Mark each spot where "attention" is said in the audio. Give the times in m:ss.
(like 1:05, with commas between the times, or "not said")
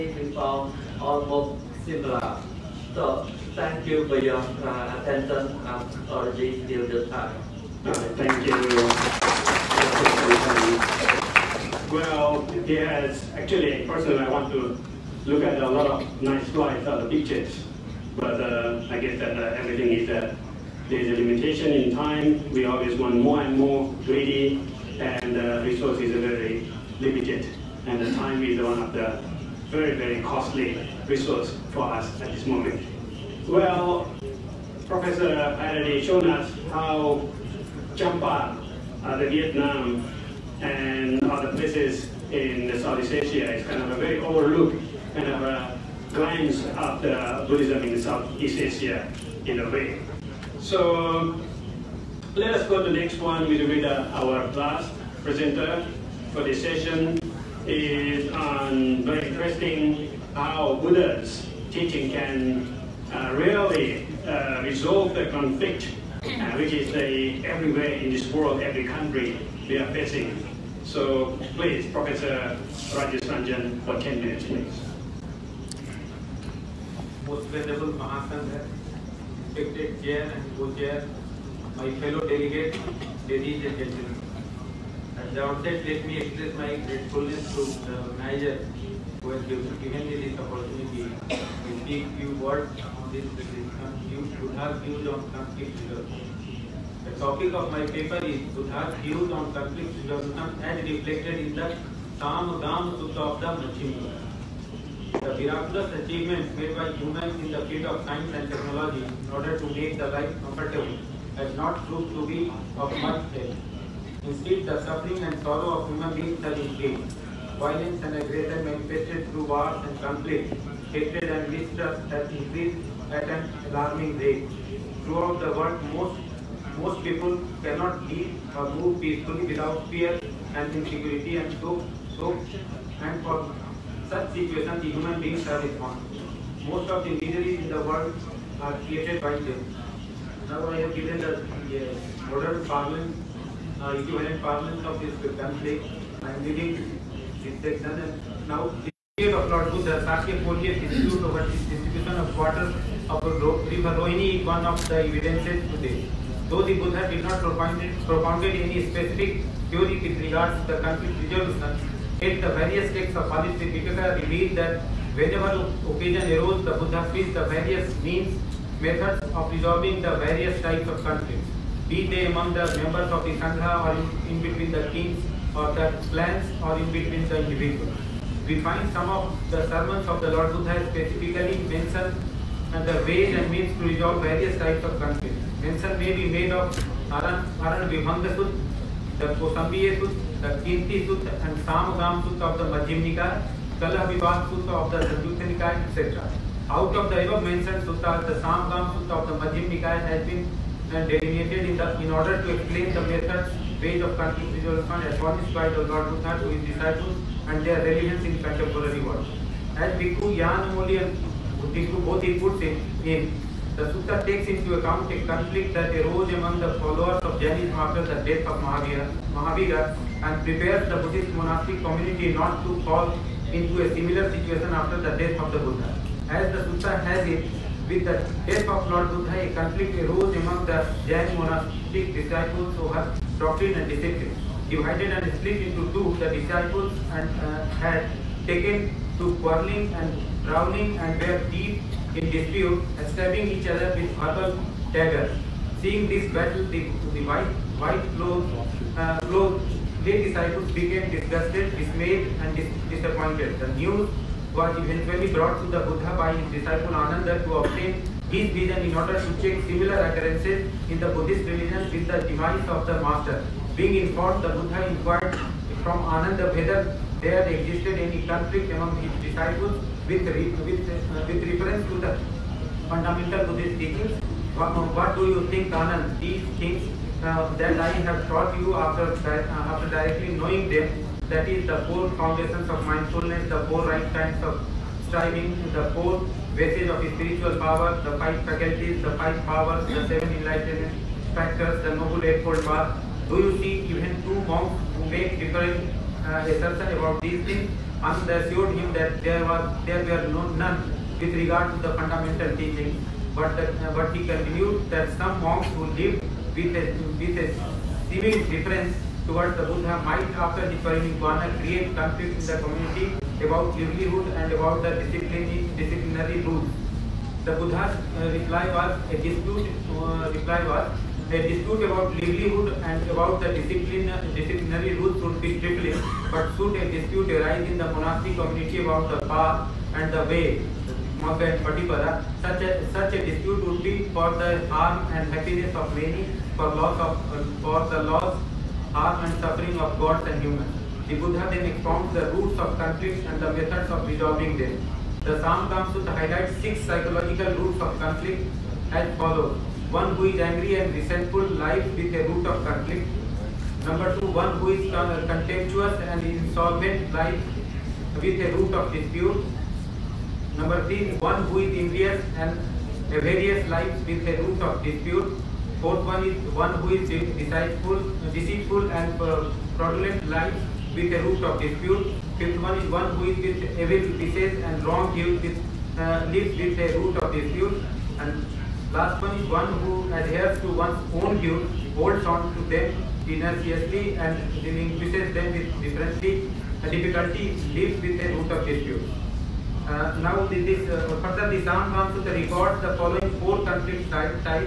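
0:05.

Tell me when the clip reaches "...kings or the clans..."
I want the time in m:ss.
2:54.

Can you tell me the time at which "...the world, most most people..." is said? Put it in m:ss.
2:05.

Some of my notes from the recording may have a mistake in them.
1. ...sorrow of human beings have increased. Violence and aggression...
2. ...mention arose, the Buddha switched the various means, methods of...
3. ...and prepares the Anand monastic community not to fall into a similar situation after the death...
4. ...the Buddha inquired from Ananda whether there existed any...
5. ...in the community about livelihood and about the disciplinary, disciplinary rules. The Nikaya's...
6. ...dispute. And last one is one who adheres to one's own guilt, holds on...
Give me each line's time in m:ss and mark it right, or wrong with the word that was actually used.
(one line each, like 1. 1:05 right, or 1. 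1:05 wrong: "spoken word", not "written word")
1. 1:55 right
2. 2:45 wrong: "occasion", not "mention"
3. 3:40 wrong: "Buddhist", not "Anand"
4. 4:24 right
5. 5:12 wrong: "Buddha", not "Nikaya"
6. 6:17 right.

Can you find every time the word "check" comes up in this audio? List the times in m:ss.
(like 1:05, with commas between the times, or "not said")
4:19.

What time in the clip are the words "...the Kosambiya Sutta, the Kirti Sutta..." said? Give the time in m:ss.
3:09.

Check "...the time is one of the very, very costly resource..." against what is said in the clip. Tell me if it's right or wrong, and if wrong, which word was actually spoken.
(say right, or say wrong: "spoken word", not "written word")
right.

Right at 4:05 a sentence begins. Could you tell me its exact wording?
Seeing this battle, the, the white, white clothes, uh, clothes They decided to became disgusted, dismayed, and dis disappointed.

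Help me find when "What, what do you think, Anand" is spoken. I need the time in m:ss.
4:34.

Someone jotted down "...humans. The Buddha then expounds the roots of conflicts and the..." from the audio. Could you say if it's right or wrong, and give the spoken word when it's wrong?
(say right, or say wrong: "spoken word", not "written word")
right.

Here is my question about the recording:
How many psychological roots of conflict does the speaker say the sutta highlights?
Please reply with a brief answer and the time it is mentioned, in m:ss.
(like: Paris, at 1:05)
6, at 5:46.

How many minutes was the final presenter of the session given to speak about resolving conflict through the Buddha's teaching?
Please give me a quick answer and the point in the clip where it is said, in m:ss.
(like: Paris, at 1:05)
10, at 1:13.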